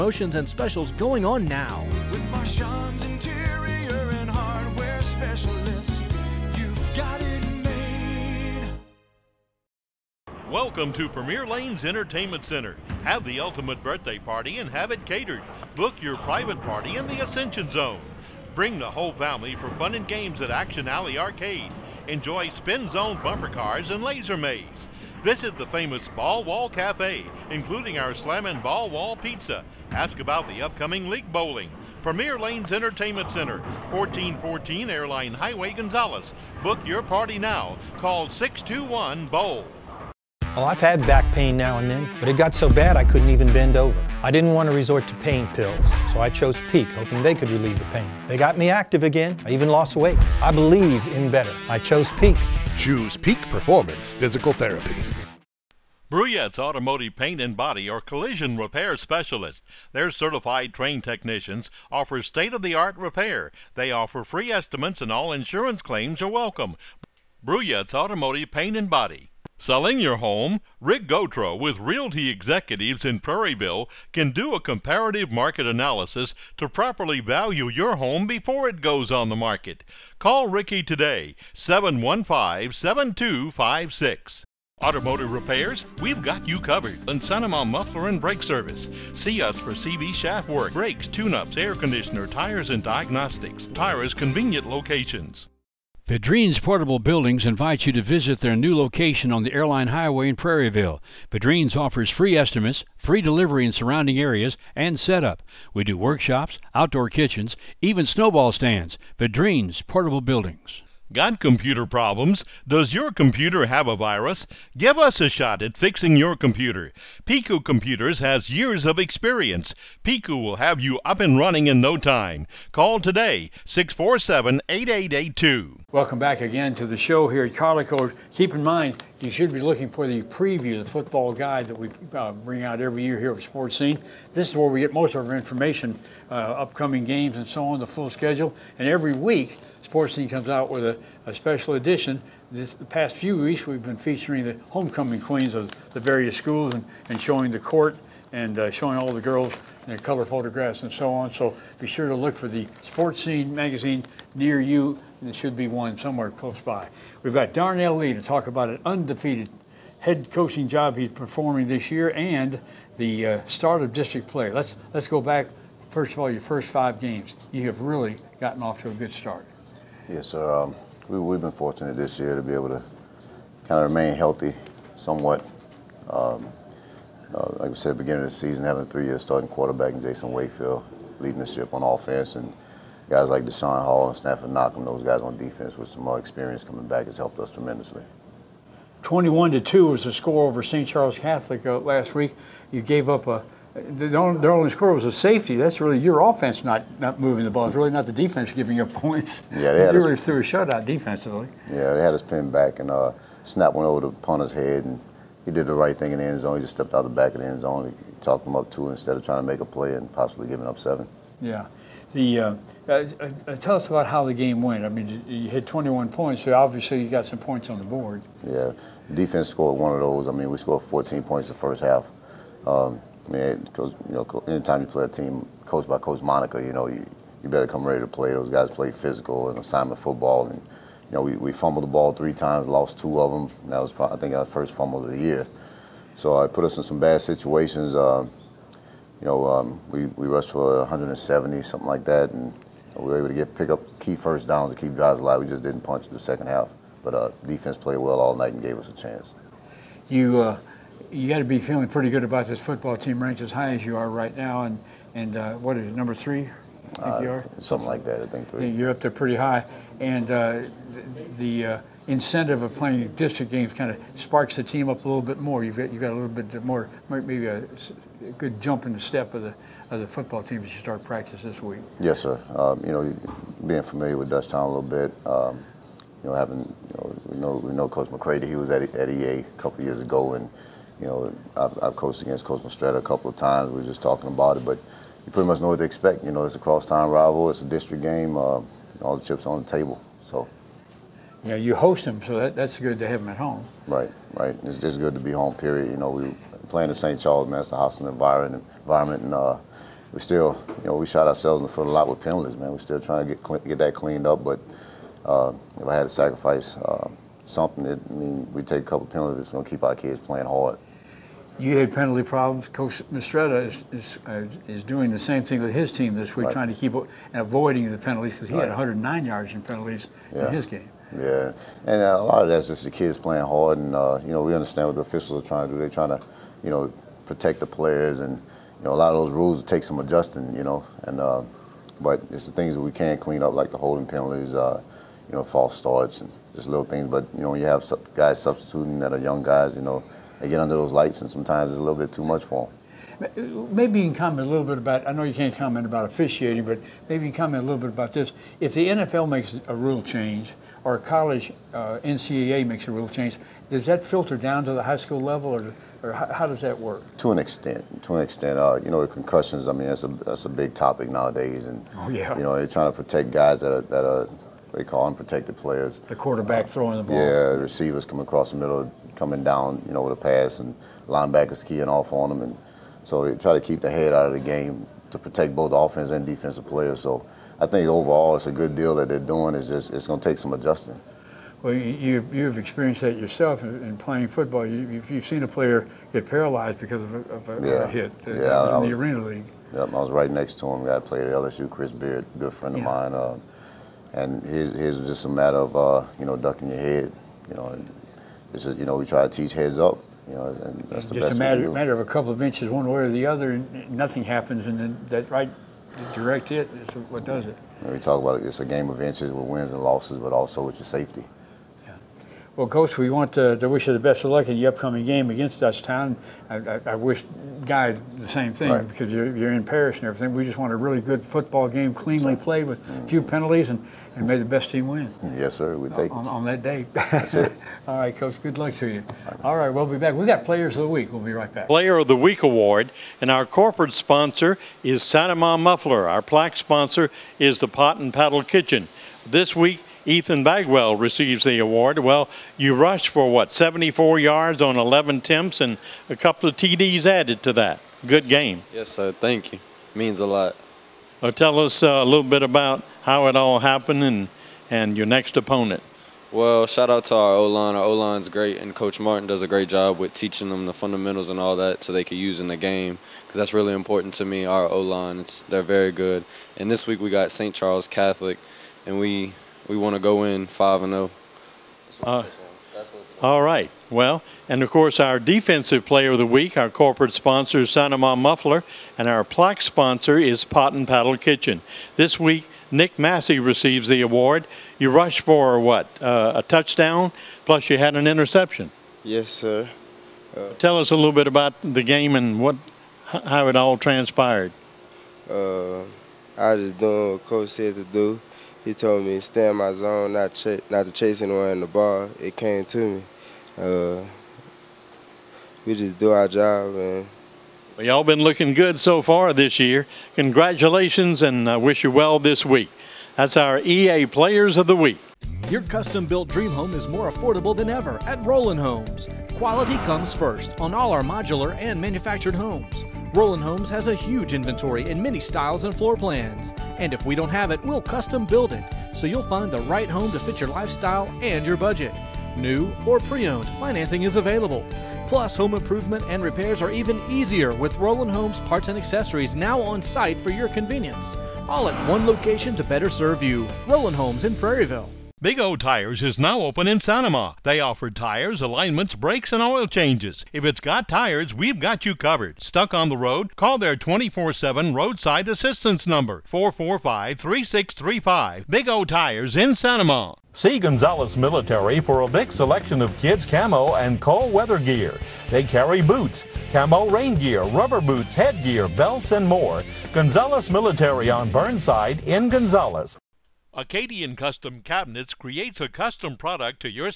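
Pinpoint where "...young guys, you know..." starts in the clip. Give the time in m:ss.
5:39.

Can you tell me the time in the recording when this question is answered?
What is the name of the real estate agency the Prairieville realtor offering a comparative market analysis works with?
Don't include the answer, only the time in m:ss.
1:11.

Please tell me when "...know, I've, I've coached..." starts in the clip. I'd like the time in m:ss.
4:41.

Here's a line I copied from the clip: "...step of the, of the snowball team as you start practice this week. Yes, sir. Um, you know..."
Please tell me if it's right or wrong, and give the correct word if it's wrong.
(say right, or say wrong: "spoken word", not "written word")
wrong: "football", not "snowball".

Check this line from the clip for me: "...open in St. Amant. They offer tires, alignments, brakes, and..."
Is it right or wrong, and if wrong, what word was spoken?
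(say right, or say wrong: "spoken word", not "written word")
right.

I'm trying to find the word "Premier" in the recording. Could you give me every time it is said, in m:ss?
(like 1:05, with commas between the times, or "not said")
0:11, 0:32.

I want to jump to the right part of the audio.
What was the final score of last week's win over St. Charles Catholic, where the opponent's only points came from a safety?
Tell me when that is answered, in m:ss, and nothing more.
3:09.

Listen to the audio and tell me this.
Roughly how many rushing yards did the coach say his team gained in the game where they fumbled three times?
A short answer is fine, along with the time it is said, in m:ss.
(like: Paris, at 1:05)
170, at 4:00.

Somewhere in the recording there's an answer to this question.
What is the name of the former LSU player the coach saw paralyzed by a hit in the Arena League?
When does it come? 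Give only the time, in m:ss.
6:31.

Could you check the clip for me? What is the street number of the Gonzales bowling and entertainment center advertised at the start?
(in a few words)
1414.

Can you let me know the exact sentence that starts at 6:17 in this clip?
So I think overall it's a good deal that they're doing.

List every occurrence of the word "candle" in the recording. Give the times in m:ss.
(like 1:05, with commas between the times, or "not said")
not said.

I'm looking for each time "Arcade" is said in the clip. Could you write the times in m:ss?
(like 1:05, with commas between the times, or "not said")
0:21.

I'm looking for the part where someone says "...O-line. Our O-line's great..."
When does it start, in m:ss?
7:37.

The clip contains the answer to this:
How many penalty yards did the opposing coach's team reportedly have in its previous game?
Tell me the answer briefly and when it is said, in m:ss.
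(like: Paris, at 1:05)
109, at 5:18.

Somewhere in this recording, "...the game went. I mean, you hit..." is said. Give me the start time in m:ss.
3:34.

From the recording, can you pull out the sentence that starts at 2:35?
There should be one somewhere close by.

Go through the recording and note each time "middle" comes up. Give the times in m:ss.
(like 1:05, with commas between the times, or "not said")
6:08.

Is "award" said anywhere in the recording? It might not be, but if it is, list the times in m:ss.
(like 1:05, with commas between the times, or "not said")
7:12, 7:21, 8:04.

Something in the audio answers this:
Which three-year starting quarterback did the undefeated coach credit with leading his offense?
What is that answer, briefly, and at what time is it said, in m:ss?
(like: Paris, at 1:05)
Jason Wakefield, at 3:00.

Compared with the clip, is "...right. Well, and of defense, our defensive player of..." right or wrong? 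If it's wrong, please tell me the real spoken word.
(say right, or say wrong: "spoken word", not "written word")
wrong: "course", not "defense".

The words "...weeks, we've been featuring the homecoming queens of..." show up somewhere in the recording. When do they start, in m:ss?
2:23.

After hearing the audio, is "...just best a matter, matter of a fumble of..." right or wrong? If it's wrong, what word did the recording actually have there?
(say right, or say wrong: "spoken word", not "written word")
wrong: "couple", not "fumble".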